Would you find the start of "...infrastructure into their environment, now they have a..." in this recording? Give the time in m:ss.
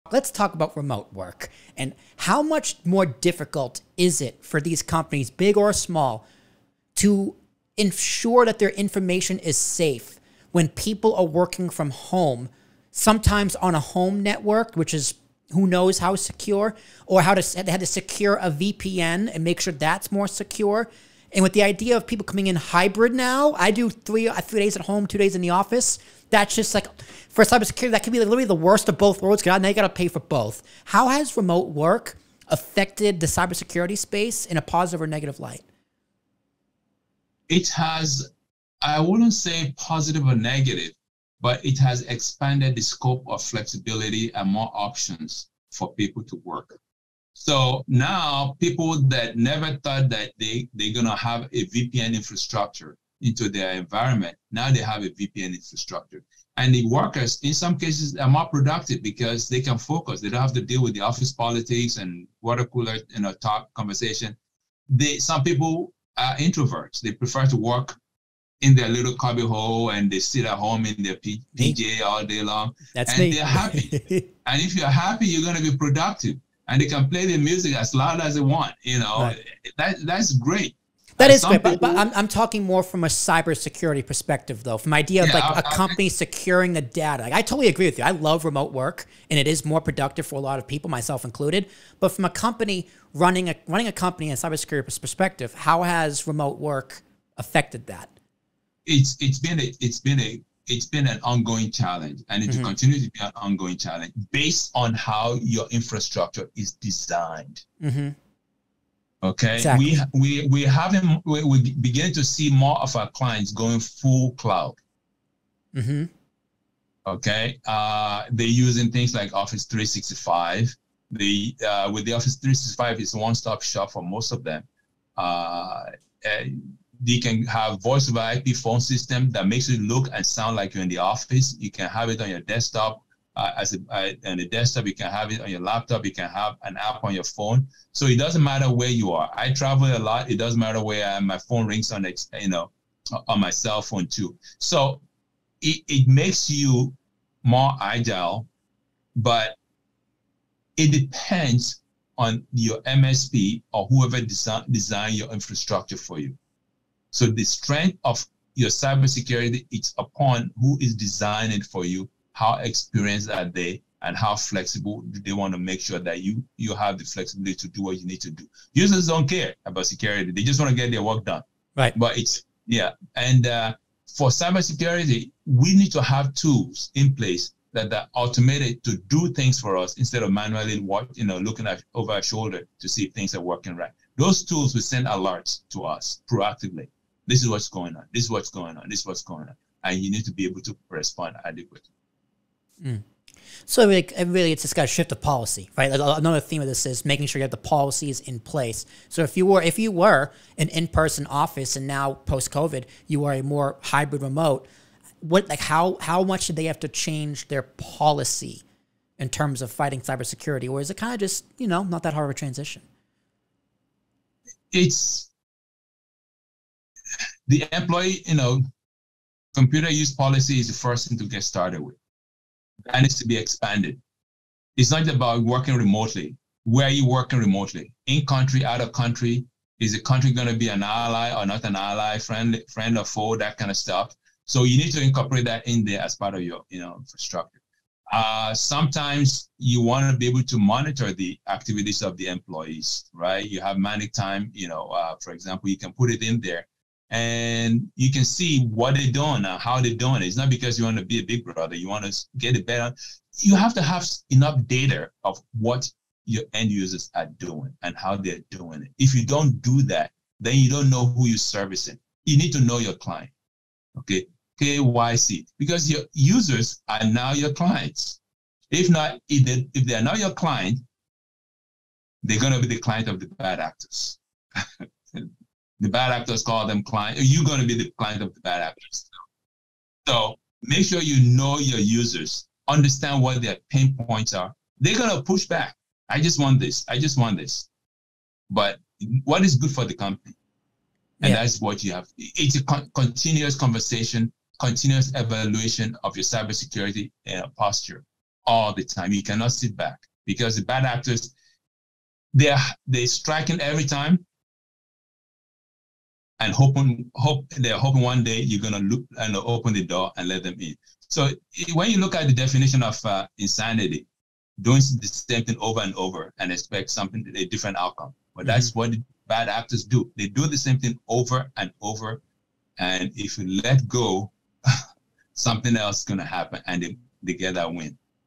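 0:52.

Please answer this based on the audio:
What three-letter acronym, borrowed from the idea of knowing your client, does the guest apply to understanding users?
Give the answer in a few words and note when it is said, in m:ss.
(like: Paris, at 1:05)
KYC, at 4:24.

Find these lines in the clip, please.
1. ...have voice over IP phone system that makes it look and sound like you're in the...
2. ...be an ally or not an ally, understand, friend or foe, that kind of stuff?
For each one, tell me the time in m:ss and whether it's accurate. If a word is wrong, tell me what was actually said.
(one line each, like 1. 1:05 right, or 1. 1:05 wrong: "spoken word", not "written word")
1. 2:07 right
2. 3:50 wrong: "friend", not "understand".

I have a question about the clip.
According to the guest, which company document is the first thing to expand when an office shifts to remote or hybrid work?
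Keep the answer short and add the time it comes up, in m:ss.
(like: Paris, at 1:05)
computer use policy, at 3:39.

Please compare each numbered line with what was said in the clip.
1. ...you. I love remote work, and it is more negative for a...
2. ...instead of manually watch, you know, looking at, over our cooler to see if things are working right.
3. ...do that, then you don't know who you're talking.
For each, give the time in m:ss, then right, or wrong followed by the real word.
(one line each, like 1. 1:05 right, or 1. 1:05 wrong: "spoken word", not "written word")
1. 1:27 wrong: "productive", not "negative"
2. 2:59 wrong: "shoulder", not "cooler"
3. 4:19 wrong: "servicing", not "talking".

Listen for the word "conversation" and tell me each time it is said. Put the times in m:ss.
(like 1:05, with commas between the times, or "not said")
1:03, 4:53.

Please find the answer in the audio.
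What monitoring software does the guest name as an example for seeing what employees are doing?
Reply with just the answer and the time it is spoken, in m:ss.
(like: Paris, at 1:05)
ManicTime, at 4:03.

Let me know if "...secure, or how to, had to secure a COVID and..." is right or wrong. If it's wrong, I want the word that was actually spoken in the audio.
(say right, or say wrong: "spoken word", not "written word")
wrong: "VPN", not "COVID".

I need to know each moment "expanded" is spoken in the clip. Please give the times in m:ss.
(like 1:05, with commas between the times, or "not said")
0:42, 3:43.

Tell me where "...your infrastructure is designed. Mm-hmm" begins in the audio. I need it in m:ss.
1:45.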